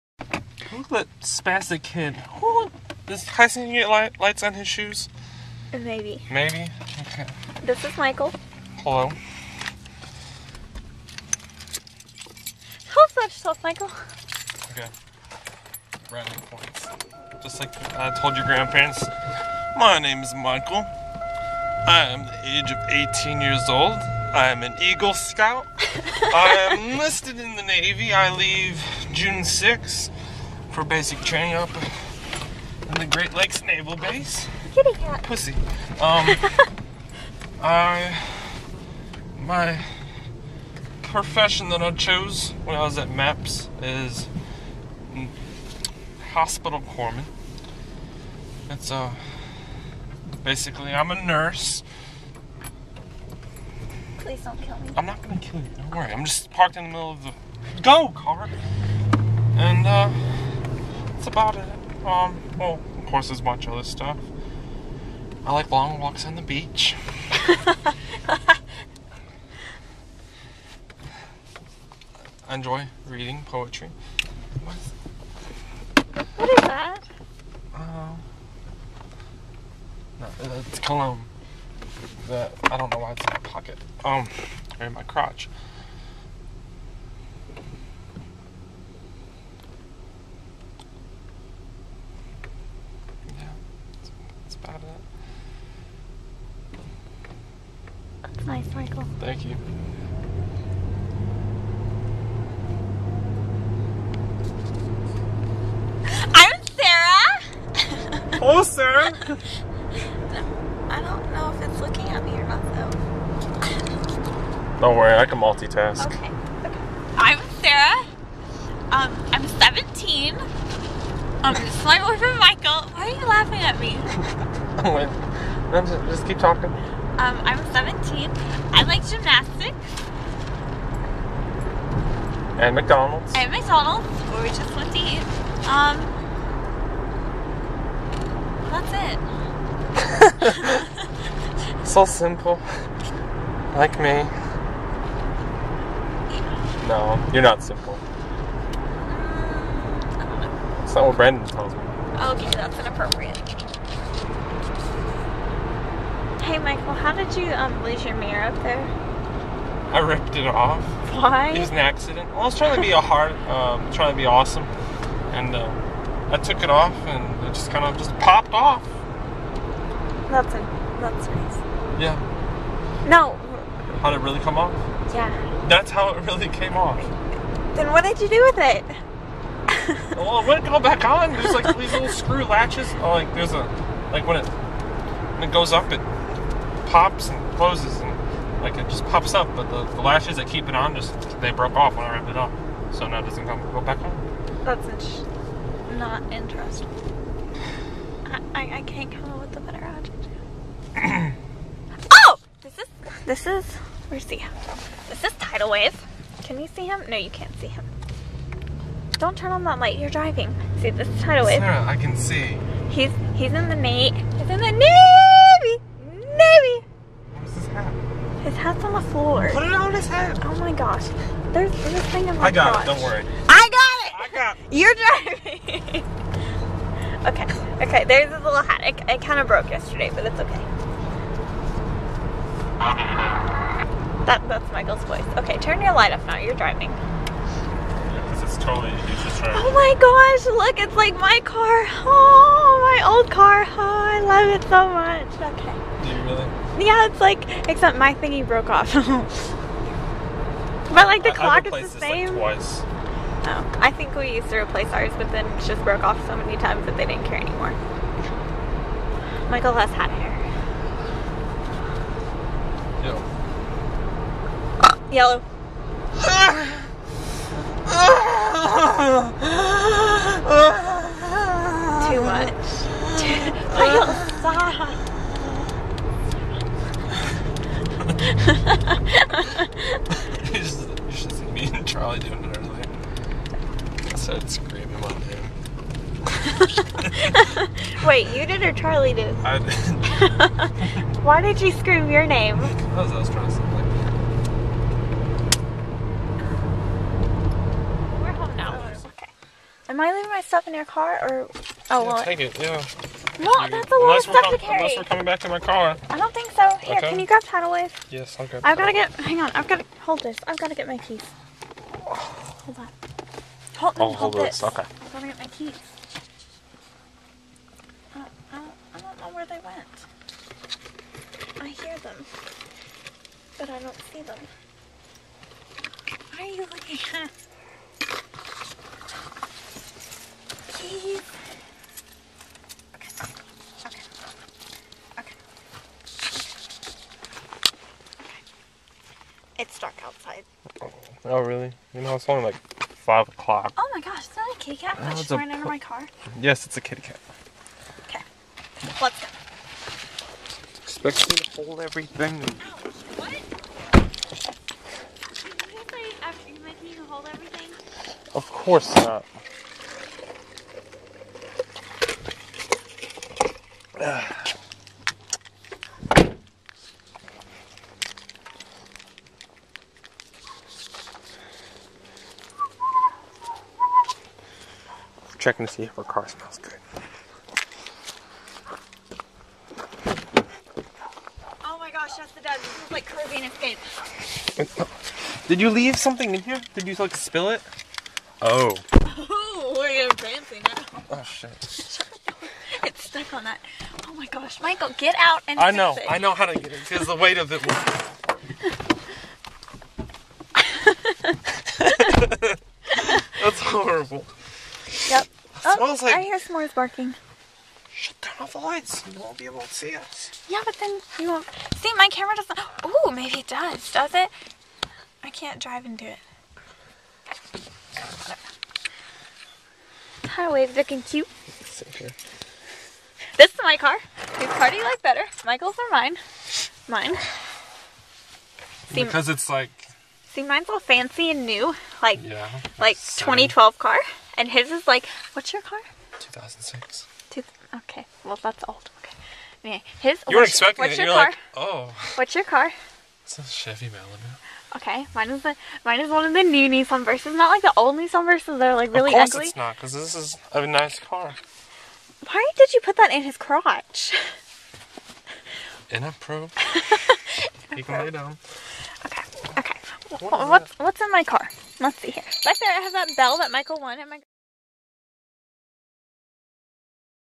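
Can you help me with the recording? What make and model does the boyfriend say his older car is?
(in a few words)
Chevy Malibu.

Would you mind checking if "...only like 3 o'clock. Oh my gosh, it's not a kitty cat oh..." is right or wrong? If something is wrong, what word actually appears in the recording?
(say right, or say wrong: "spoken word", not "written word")
wrong: "5", not "3".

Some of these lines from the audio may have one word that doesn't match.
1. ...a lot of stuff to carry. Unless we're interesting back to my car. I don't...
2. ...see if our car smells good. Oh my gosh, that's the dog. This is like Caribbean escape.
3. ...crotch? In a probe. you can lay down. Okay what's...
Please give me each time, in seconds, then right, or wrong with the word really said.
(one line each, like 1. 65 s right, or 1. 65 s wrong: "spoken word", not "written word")
1. 303 s wrong: "coming", not "interesting"
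2. 375 s right
3. 453 s right.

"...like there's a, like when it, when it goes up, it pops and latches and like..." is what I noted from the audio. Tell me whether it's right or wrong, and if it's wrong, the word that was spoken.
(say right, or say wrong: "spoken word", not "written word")
wrong: "closes", not "latches".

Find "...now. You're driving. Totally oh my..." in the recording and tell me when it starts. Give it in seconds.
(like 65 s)
236 s.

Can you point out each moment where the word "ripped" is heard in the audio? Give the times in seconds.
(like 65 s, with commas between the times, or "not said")
159 s, 192 s.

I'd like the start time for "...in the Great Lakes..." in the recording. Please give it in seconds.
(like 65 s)
32 s.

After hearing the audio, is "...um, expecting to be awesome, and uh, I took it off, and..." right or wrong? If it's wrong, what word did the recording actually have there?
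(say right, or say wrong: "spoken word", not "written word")
wrong: "trying", not "expecting".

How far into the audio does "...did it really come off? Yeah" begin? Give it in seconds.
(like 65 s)
174 s.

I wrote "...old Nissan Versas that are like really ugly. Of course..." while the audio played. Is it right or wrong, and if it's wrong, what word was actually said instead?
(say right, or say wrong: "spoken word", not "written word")
right.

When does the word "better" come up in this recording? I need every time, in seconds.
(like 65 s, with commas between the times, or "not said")
199 s, 425 s.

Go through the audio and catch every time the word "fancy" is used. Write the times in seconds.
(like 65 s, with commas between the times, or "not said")
390 s, 430 s.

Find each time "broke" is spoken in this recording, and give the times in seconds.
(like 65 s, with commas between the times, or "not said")
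191 s, 229 s, 248 s, 255 s.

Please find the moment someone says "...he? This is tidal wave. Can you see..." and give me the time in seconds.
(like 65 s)
204 s.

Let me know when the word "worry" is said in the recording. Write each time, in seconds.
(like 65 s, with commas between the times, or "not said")
55 s, 114 s, 223 s.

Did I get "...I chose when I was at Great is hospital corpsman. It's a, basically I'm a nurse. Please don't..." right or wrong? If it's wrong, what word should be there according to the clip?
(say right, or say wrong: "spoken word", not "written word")
wrong: "MEPS", not "Great".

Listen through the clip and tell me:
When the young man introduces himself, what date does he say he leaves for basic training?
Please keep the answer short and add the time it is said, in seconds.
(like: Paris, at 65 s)
June 6th, at 29 s.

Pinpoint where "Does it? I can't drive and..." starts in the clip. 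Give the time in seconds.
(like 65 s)
413 s.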